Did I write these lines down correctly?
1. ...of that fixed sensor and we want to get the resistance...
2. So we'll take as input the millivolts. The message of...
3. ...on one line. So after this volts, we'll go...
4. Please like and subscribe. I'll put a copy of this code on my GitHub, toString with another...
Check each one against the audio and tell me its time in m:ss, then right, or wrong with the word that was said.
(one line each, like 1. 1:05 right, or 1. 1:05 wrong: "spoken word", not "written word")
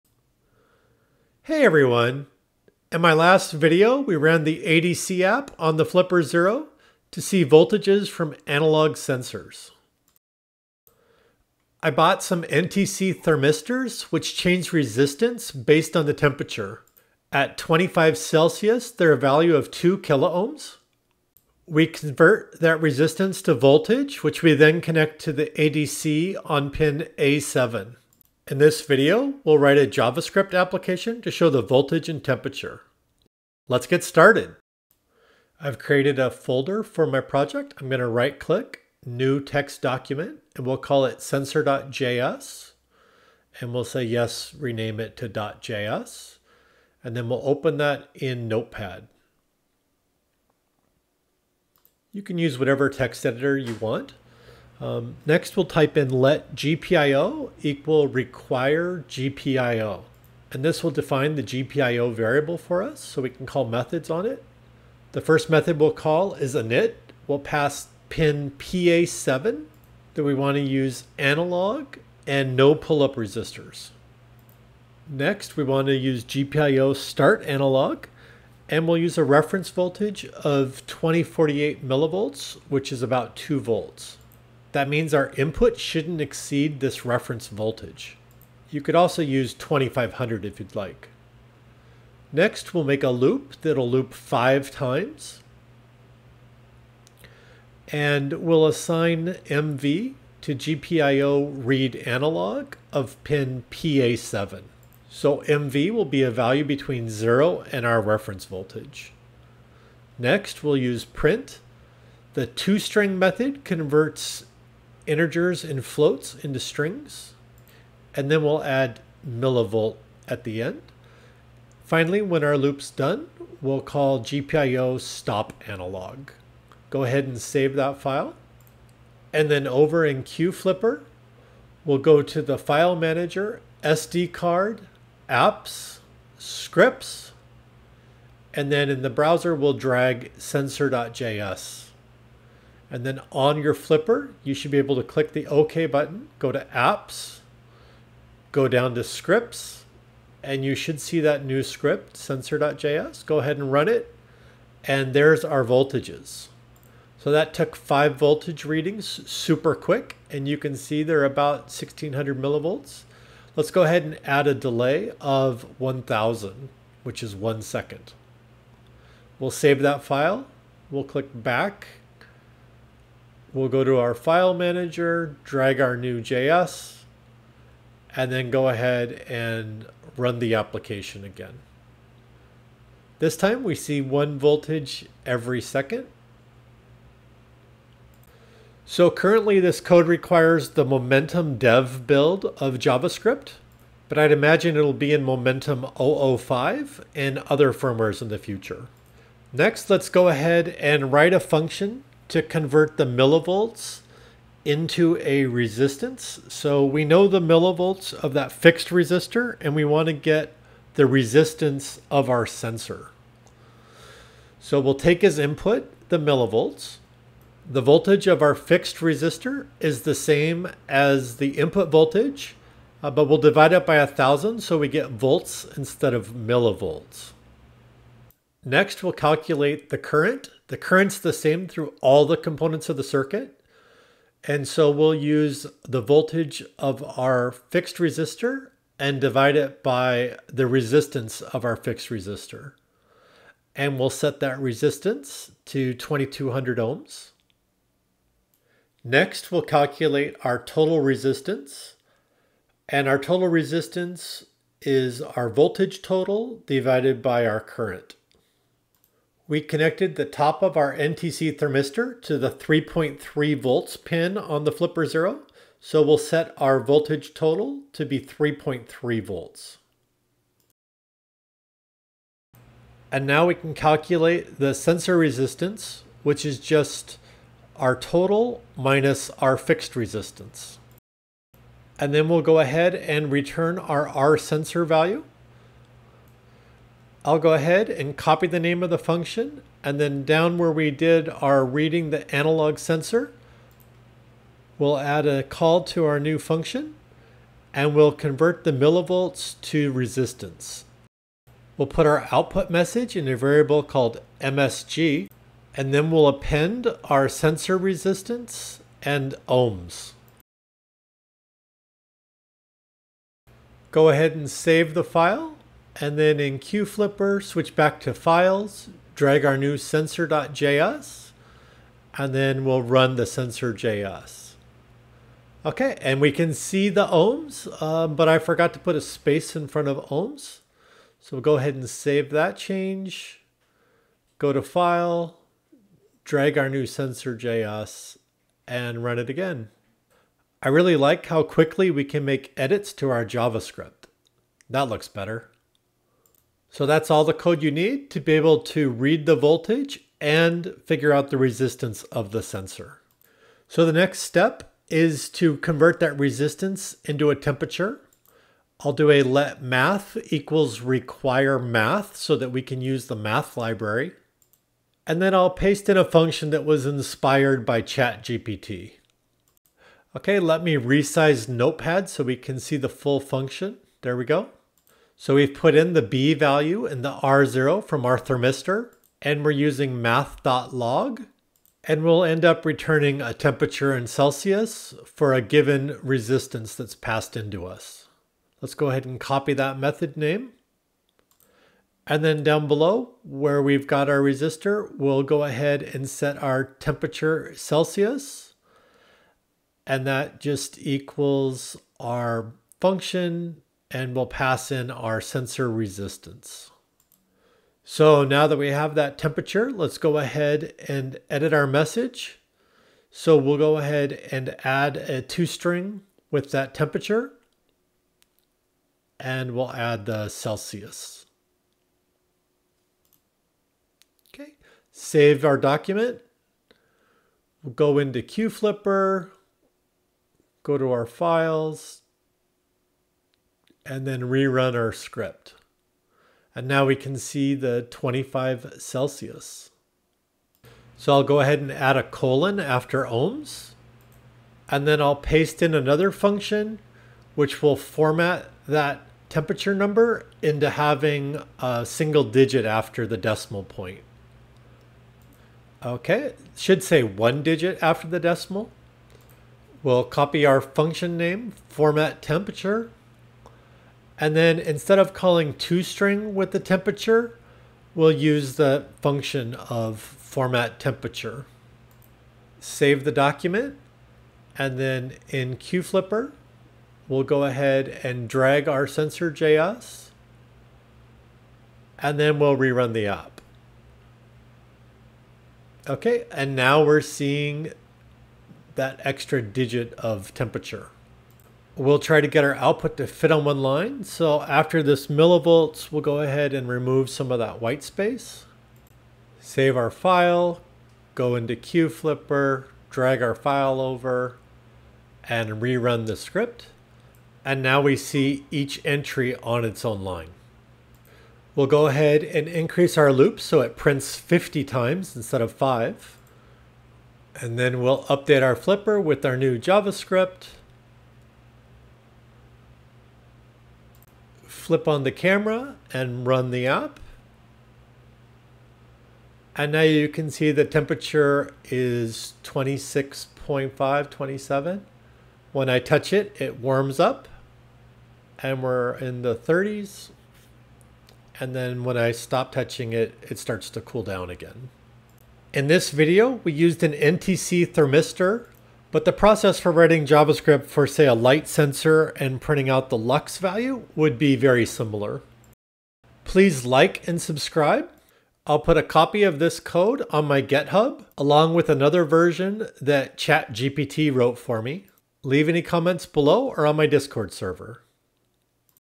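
1. 3:28 wrong: "resistor", not "sensor"
2. 3:34 wrong: "voltage", not "message"
3. 8:13 wrong: "millivolts", not "volts"
4. 9:16 wrong: "along", not "toString".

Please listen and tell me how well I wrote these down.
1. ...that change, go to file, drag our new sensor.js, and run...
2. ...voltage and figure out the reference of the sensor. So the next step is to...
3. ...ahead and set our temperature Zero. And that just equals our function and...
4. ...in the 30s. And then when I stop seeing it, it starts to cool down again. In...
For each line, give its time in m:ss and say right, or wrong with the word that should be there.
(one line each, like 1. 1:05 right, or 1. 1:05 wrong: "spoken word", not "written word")
1. 5:32 right
2. 5:49 wrong: "resistance", not "reference"
3. 6:35 wrong: "Celsius", not "Zero"
4. 8:58 wrong: "touching", not "seeing".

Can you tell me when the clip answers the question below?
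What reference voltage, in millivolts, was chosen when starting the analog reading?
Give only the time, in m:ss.
1:20.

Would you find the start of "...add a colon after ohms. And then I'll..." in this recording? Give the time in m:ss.
7:21.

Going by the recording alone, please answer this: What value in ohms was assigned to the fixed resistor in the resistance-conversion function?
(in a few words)
2200.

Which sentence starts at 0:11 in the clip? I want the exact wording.
I bought some NTC thermistors which change resistance based on the temperature.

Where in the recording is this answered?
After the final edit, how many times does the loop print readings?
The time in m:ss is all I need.
8:34.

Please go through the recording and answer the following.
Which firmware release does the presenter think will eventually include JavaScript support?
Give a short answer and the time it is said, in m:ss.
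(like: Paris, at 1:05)
Momentum 005, at 3:15.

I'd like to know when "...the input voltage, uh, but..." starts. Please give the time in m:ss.
3:41.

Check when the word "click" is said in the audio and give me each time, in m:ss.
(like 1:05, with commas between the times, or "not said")
0:38, 2:25, 2:51.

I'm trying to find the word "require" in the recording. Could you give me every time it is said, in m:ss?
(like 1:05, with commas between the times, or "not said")
0:58, 3:10, 6:00.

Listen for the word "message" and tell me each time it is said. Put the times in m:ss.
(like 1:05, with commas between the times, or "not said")
5:02, 6:51.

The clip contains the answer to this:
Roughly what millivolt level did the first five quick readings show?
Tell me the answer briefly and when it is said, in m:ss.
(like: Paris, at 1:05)
1600, at 2:41.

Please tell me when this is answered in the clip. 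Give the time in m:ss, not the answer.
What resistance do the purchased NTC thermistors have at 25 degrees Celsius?
0:19.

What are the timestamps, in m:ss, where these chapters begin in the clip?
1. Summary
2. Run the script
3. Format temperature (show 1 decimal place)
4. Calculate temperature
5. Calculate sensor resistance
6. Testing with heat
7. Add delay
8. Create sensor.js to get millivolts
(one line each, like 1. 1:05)
1. 9:05
2. 2:08
3. 7:24
4. 5:54
5. 3:19
6. 8:31
7. 2:37
8. 0:35.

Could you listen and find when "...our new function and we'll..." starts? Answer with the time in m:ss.
4:56.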